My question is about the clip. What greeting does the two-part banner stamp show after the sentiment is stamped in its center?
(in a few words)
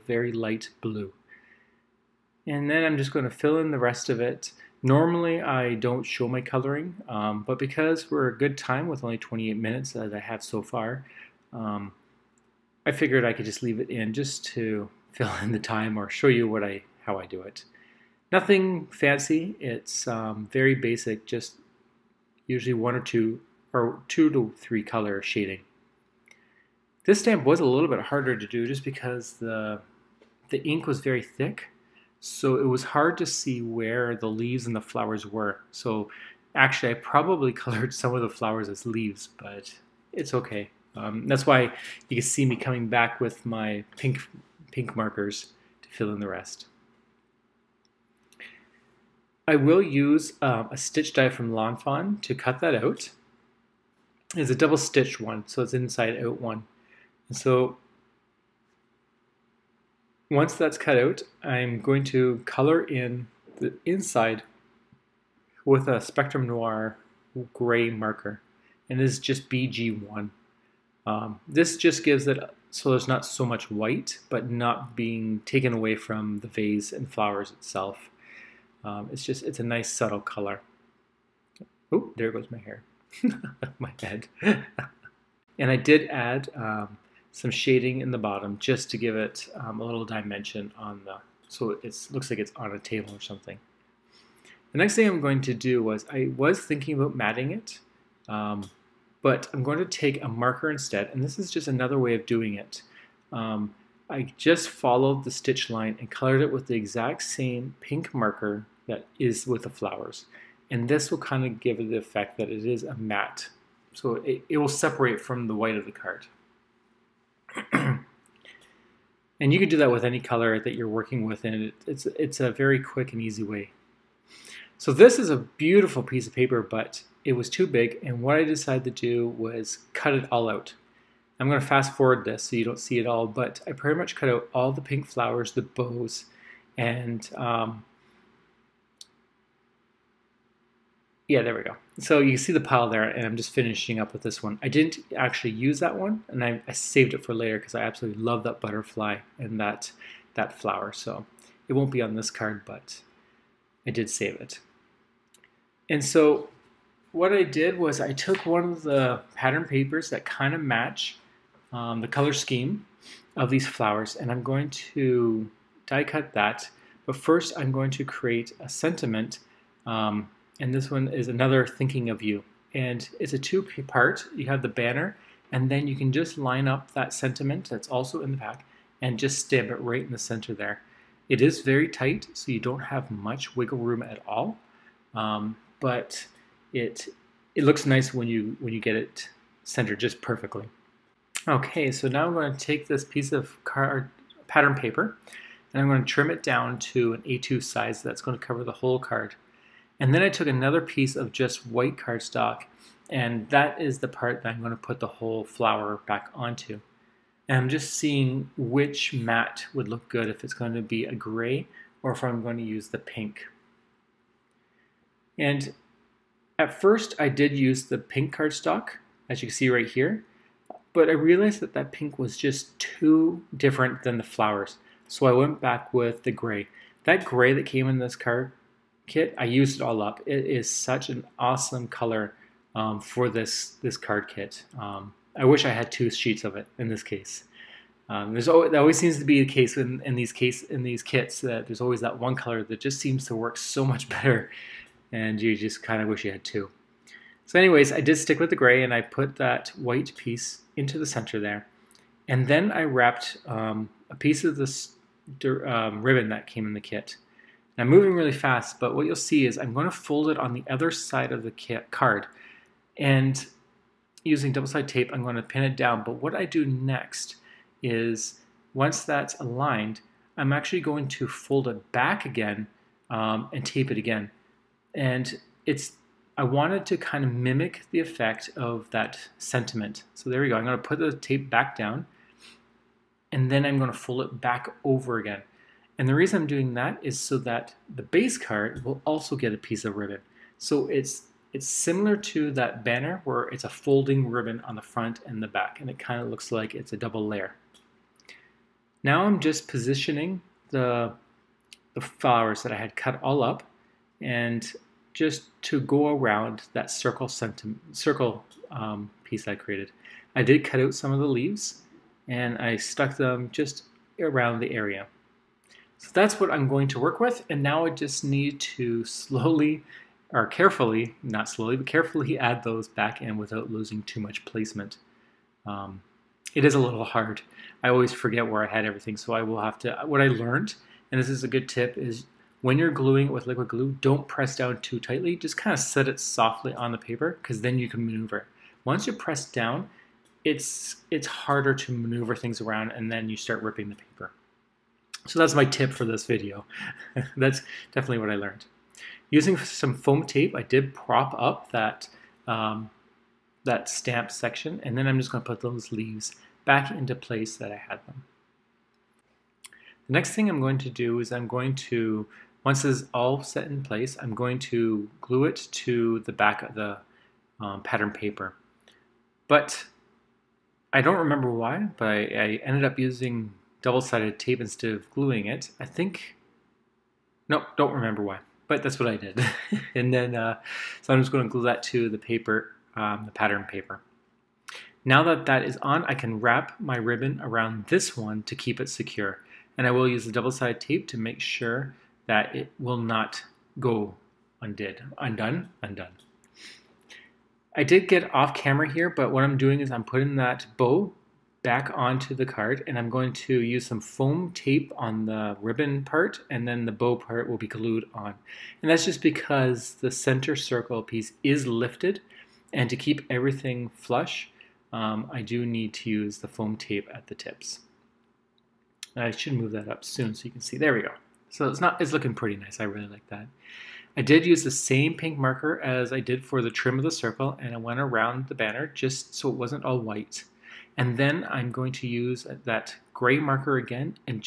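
Thinking of you.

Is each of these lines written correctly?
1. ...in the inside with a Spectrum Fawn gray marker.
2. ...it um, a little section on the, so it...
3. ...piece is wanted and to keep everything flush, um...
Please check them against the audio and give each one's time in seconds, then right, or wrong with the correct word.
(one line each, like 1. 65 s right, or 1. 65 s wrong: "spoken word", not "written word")
1. 62 s wrong: "Noir", not "Fawn"
2. 89 s wrong: "dimension", not "section"
3. 411 s wrong: "lifted", not "wanted".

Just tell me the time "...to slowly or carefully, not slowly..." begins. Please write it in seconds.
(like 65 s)
318 s.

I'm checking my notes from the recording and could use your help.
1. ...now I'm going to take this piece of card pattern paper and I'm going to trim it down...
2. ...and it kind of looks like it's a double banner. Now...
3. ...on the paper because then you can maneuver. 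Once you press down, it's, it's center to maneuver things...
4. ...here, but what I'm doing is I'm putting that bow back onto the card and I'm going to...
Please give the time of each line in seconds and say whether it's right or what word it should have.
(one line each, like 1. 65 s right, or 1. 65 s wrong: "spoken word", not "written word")
1. 192 s right
2. 295 s wrong: "layer", not "banner"
3. 336 s wrong: "harder", not "center"
4. 398 s right.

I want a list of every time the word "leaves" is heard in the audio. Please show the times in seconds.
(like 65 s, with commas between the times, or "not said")
13 s, 34 s, 38 s, 311 s, 355 s.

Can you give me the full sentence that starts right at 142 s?
So you see the pile there, and I'm just finishing up with this one.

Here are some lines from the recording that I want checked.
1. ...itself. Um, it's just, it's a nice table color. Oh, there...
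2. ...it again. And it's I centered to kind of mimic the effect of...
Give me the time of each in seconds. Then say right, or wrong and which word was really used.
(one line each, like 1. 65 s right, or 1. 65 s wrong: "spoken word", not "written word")
1. 77 s wrong: "subtle", not "table"
2. 273 s wrong: "wanted", not "centered".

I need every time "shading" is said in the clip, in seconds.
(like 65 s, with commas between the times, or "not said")
25 s, 87 s.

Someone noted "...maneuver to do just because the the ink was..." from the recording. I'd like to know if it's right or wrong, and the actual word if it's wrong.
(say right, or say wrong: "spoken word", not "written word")
wrong: "harder", not "maneuver".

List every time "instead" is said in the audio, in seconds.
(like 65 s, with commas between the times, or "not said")
100 s, 374 s.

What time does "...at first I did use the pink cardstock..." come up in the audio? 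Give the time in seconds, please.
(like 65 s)
216 s.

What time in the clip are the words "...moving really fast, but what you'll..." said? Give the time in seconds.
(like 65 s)
257 s.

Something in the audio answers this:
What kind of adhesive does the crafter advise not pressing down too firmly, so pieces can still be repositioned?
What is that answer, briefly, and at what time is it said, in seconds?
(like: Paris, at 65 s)
liquid glue, at 333 s.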